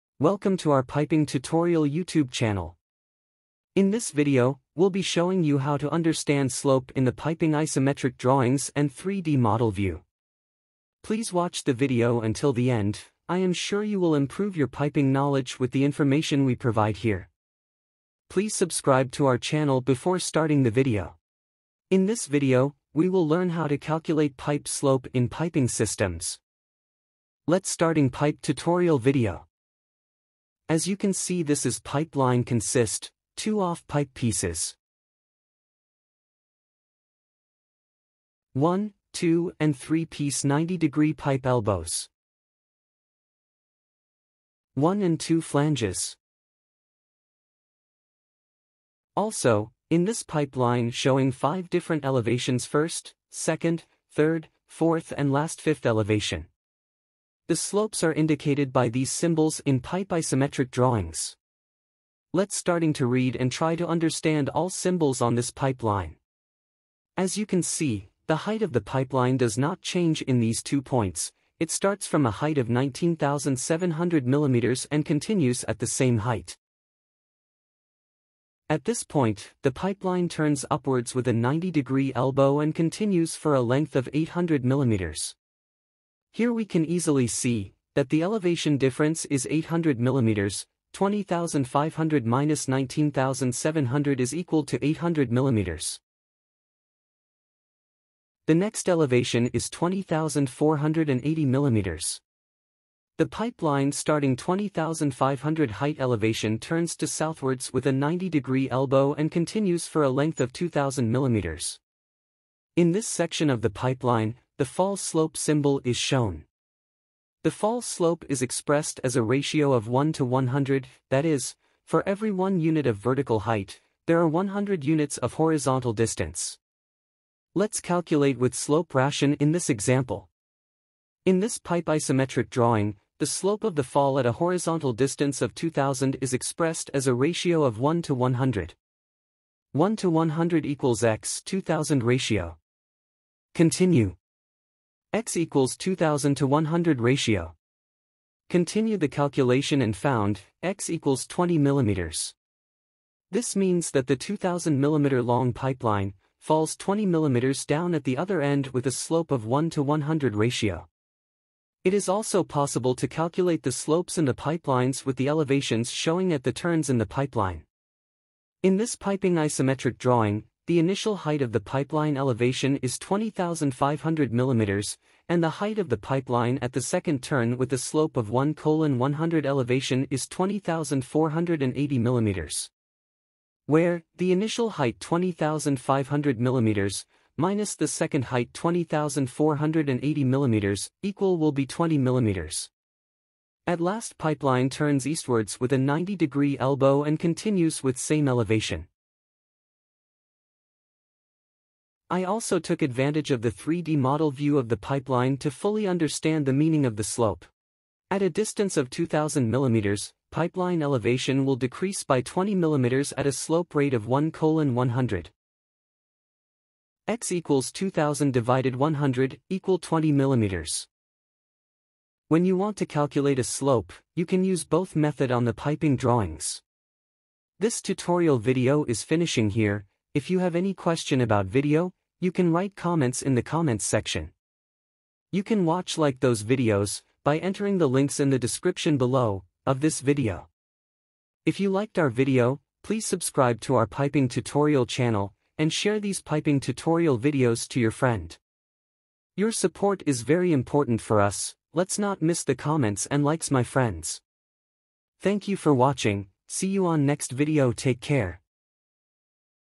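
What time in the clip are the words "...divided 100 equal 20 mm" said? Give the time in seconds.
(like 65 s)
218 s.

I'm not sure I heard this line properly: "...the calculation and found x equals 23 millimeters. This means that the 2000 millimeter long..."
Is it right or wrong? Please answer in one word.
wrong.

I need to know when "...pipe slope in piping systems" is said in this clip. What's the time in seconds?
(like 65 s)
24 s.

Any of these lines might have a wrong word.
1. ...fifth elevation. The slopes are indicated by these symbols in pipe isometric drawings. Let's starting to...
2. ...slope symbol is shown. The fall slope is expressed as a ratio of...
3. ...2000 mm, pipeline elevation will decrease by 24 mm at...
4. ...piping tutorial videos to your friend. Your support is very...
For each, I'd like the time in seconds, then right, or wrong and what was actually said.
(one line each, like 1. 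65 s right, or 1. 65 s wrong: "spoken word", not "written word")
1. 55 s right
2. 114 s right
3. 208 s wrong: "20", not "24"
4. 246 s right.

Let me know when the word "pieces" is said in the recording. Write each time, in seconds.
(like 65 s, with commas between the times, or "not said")
34 s, 40 s.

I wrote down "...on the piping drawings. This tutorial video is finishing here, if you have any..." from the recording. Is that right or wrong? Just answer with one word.
right.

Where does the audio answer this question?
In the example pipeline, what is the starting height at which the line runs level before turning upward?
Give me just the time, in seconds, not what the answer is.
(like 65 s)
72 s.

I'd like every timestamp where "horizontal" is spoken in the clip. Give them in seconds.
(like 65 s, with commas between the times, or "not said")
125 s, 134 s.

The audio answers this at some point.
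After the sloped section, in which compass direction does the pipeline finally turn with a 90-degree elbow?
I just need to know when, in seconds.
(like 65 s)
195 s.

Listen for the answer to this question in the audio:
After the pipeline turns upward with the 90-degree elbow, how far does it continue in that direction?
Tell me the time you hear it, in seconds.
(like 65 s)
84 s.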